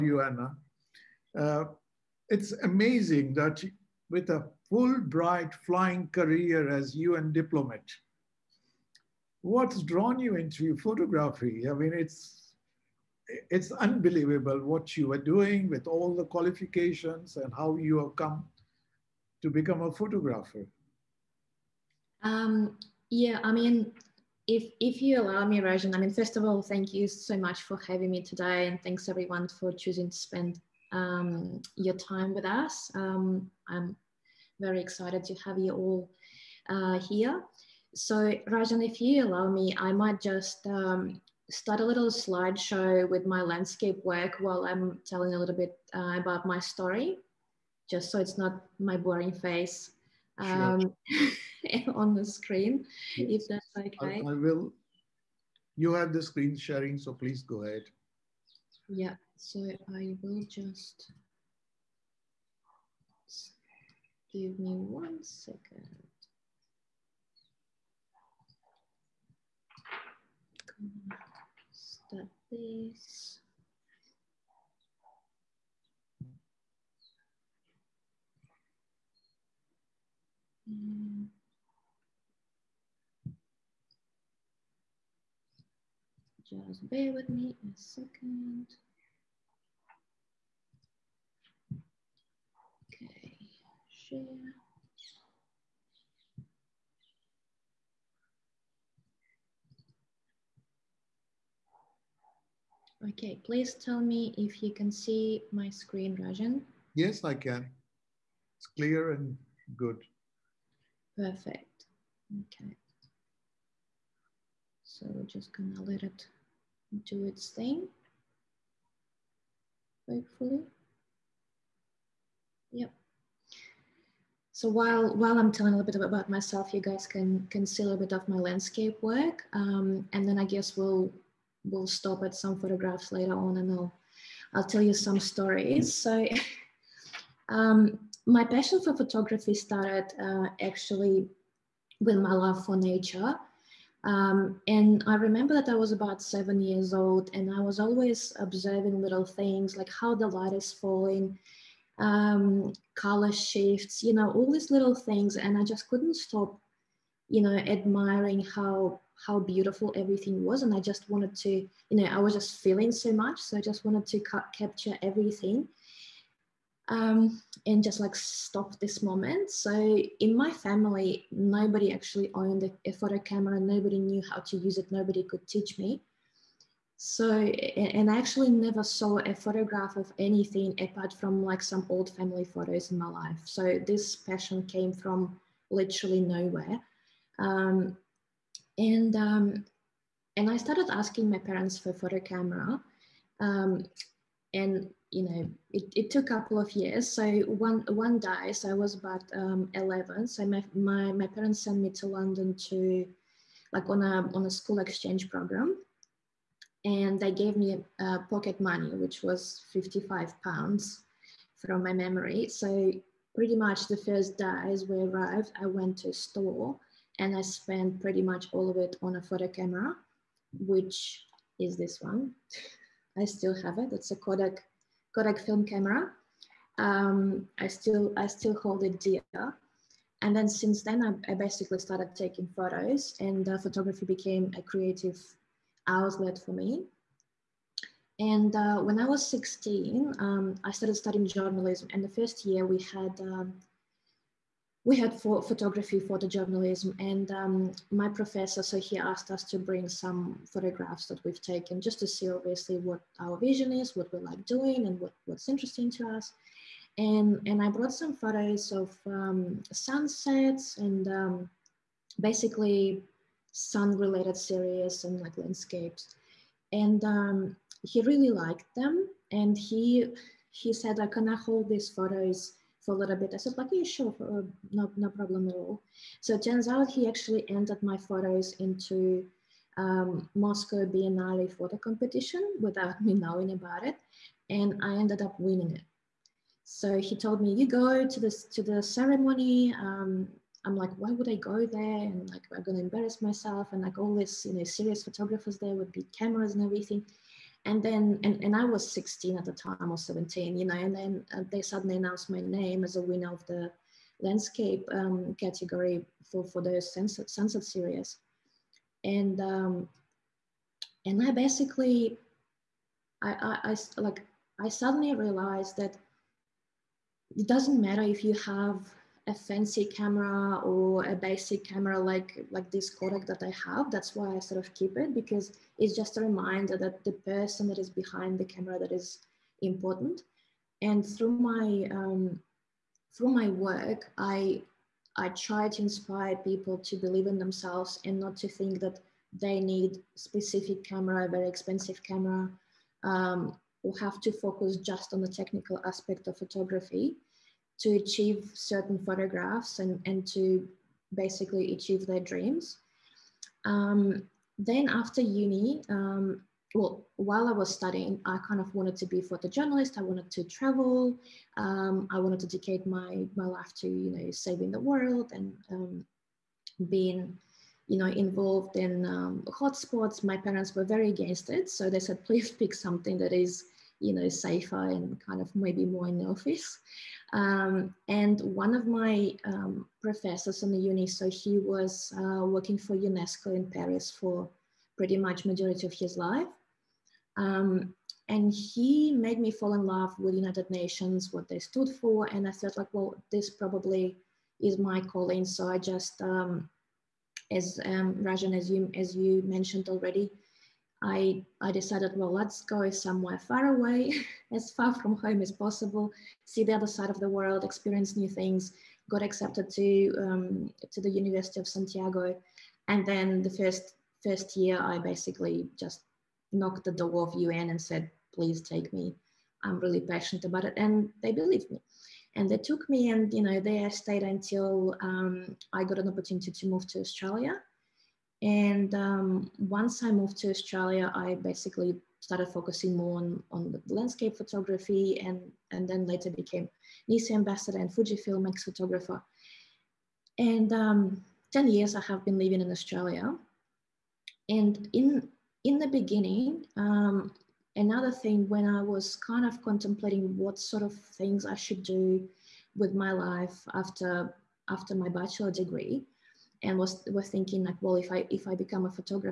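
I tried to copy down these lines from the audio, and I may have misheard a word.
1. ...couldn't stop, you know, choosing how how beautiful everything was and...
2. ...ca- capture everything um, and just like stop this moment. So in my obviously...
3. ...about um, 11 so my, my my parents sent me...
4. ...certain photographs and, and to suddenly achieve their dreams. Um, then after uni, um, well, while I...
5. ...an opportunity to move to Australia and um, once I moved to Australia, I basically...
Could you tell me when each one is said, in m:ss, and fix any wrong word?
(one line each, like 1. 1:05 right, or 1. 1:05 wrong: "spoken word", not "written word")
1. 2:35 wrong: "admiring", not "choosing"
2. 2:44 wrong: "family", not "obviously"
3. 3:18 right
4. 5:48 wrong: "basically", not "suddenly"
5. 7:05 right.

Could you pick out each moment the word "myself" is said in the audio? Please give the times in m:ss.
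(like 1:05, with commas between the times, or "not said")
2:06, 4:53.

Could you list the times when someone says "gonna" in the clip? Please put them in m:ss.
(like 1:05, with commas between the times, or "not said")
1:55, 4:52.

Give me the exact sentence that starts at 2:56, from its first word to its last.
So, and I actually never saw a photograph of anything apart from like some old family photos in my life.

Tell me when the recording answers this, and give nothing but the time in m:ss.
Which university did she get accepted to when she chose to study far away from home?
6:51.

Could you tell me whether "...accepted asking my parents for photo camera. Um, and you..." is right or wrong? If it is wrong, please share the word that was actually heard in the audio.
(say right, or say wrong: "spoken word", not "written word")
wrong: "started", not "accepted".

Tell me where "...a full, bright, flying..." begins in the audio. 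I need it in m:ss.
0:04.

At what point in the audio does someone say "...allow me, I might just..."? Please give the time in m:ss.
0:39.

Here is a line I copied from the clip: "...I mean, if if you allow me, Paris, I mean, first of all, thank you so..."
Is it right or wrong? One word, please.
wrong.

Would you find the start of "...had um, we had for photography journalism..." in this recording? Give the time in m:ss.
4:02.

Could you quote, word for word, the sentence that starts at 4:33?
I said, like, yeah, sure, uh, no, no problem at all.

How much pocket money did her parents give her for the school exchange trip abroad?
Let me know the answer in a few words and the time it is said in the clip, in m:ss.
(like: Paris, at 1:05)
55 pounds, at 3:29.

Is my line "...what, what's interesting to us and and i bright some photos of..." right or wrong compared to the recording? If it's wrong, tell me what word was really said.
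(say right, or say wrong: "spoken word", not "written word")
wrong: "brought", not "bright".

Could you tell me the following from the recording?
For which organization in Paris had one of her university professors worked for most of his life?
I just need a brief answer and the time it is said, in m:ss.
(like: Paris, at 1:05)
UNESCO, at 6:22.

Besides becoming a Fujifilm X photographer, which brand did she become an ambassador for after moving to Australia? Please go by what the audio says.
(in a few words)
NiSi.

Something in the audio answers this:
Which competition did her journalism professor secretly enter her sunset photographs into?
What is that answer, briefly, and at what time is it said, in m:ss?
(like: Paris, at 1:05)
Moscow Biennale, at 4:40.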